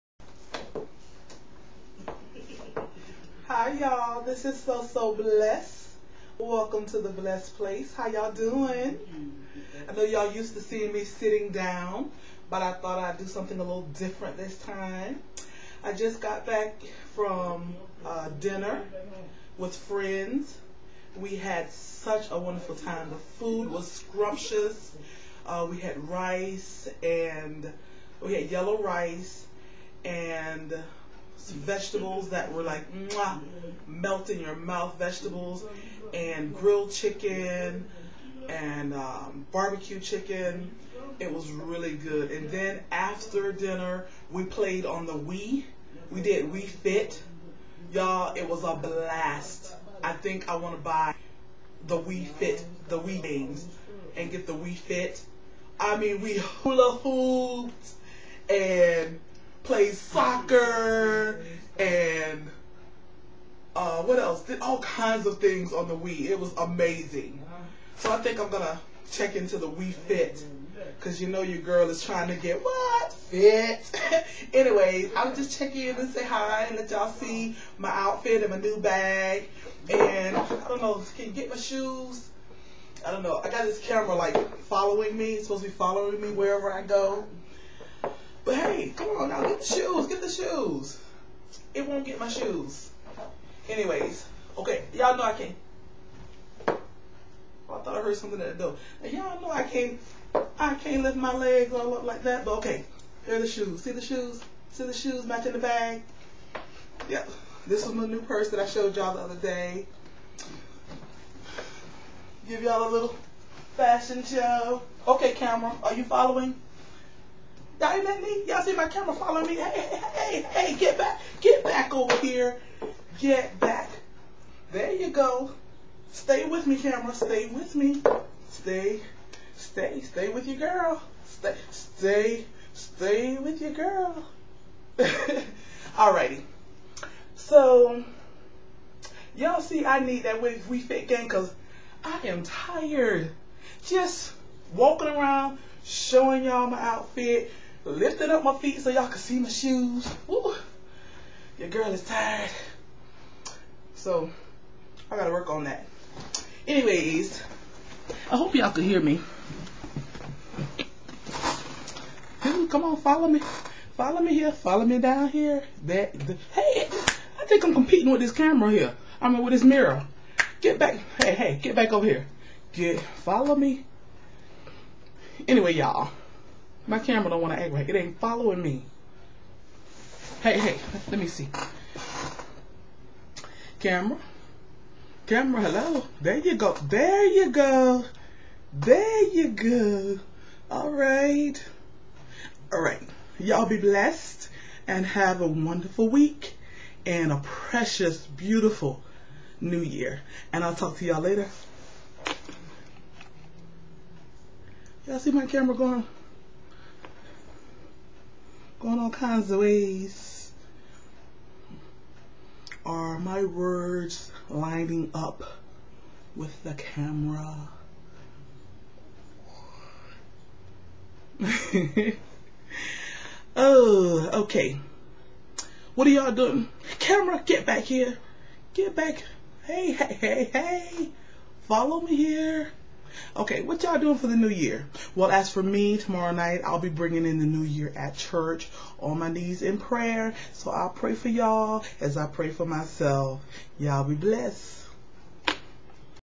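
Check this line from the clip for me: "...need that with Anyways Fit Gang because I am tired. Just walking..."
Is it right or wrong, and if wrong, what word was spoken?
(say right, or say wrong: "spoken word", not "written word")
wrong: "Wii", not "Anyways".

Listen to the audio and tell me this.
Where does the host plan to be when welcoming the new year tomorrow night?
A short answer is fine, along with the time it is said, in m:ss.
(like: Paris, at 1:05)
church, at 3:58.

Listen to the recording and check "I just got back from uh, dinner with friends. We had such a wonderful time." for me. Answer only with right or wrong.
right.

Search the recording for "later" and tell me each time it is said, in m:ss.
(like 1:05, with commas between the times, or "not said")
3:21.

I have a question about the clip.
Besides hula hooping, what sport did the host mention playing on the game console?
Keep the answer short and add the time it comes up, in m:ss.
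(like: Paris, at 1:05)
soccer, at 0:59.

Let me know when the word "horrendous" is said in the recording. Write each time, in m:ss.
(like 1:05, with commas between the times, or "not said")
not said.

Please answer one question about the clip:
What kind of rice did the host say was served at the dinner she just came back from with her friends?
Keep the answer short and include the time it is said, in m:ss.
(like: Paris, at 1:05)
yellow rice, at 0:28.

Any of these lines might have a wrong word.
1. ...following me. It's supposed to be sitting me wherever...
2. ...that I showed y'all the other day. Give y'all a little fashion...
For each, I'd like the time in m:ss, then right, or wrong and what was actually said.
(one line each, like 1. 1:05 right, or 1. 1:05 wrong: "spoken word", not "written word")
1. 1:24 wrong: "following", not "sitting"
2. 1:48 right.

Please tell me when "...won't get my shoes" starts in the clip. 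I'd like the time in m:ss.
1:31.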